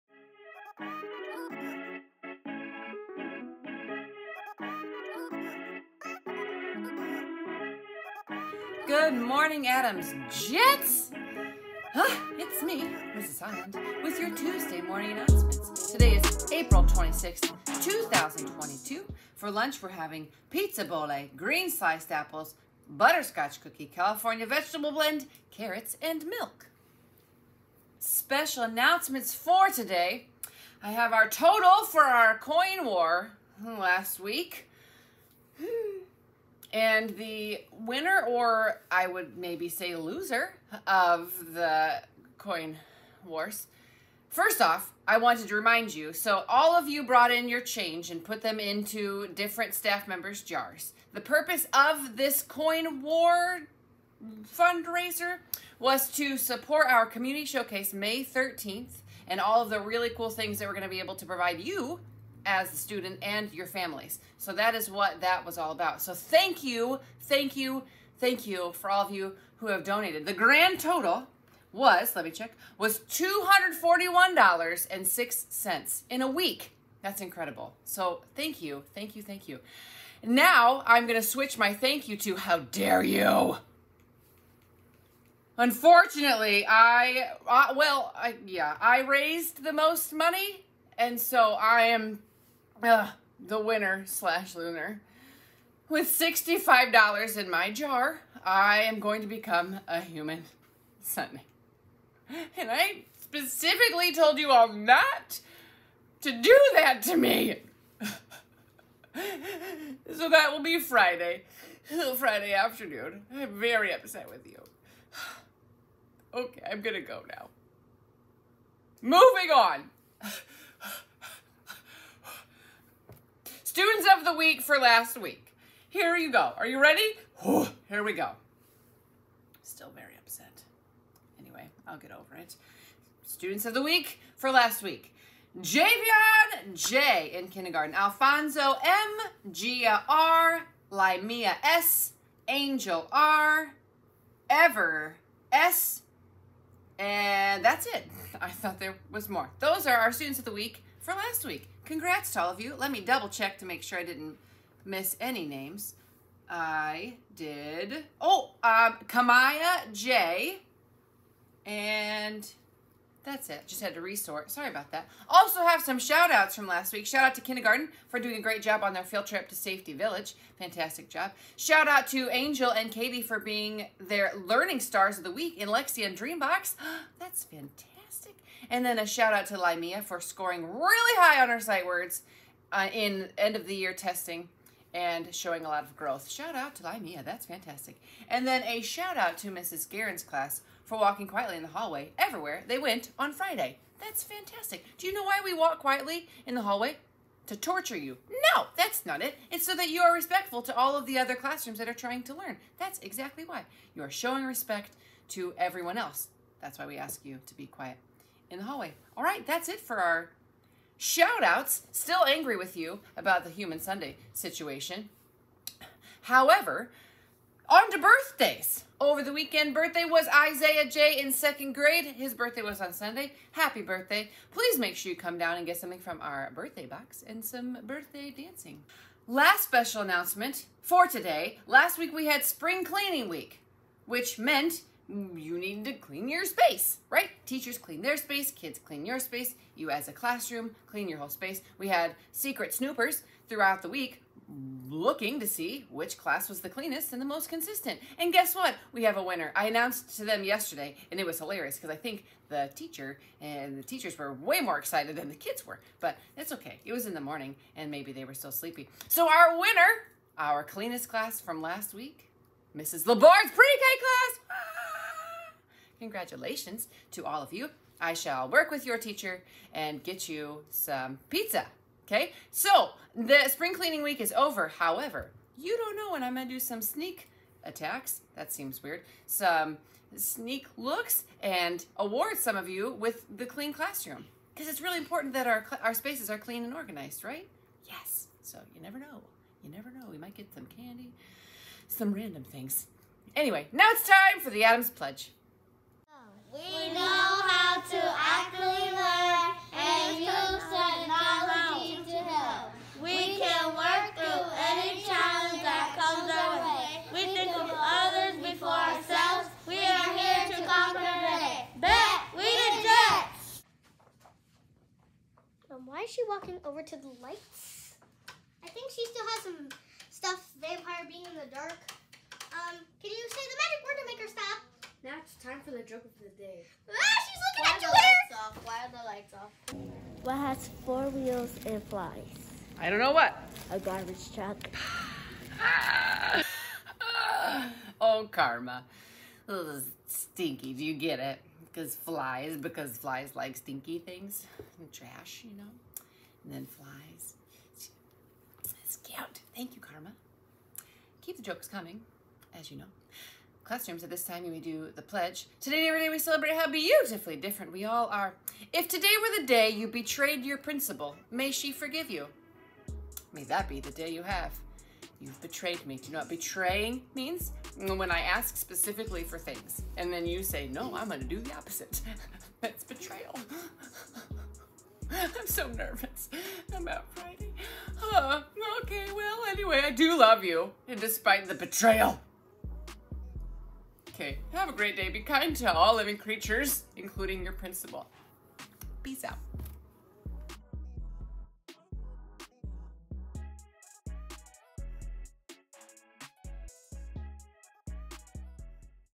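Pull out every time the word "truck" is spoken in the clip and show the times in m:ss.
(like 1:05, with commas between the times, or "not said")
5:34.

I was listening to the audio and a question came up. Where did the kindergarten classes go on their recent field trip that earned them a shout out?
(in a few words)
Safety Village.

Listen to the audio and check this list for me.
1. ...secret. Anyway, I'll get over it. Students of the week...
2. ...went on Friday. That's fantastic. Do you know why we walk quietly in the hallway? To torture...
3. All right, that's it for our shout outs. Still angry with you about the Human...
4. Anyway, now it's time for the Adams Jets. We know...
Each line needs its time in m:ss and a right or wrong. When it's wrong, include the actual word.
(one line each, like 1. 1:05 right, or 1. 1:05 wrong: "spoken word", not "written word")
1. 2:10 wrong: "upset", not "secret"
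2. 3:12 right
3. 3:29 right
4. 4:53 wrong: "Pledge", not "Jets".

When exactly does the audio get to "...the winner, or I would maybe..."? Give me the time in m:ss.
0:37.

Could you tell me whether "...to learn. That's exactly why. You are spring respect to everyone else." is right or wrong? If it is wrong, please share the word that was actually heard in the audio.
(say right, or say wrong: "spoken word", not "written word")
wrong: "showing", not "spring".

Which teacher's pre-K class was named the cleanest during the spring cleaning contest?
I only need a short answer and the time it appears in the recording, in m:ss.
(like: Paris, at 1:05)
Mrs. Labord, at 4:22.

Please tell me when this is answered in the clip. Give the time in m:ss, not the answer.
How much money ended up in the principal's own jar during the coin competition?
1:36.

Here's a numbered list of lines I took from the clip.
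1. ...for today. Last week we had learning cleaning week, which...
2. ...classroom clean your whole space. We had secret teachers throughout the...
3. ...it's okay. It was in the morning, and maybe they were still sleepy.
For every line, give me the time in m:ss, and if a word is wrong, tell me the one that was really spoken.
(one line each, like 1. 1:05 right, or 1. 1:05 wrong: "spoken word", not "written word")
1. 3:50 wrong: "spring", not "learning"
2. 4:00 wrong: "snoopers", not "teachers"
3. 4:16 right.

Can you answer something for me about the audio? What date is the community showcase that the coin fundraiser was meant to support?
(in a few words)
May 13th.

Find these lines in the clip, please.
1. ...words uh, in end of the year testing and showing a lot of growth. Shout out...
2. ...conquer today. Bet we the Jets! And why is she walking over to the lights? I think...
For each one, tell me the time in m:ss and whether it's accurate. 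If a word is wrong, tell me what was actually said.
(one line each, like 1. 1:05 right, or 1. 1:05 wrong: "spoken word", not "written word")
1. 3:01 right
2. 5:10 right.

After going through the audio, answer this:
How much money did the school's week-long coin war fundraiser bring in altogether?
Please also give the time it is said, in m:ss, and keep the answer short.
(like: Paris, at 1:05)
$241.06, at 1:13.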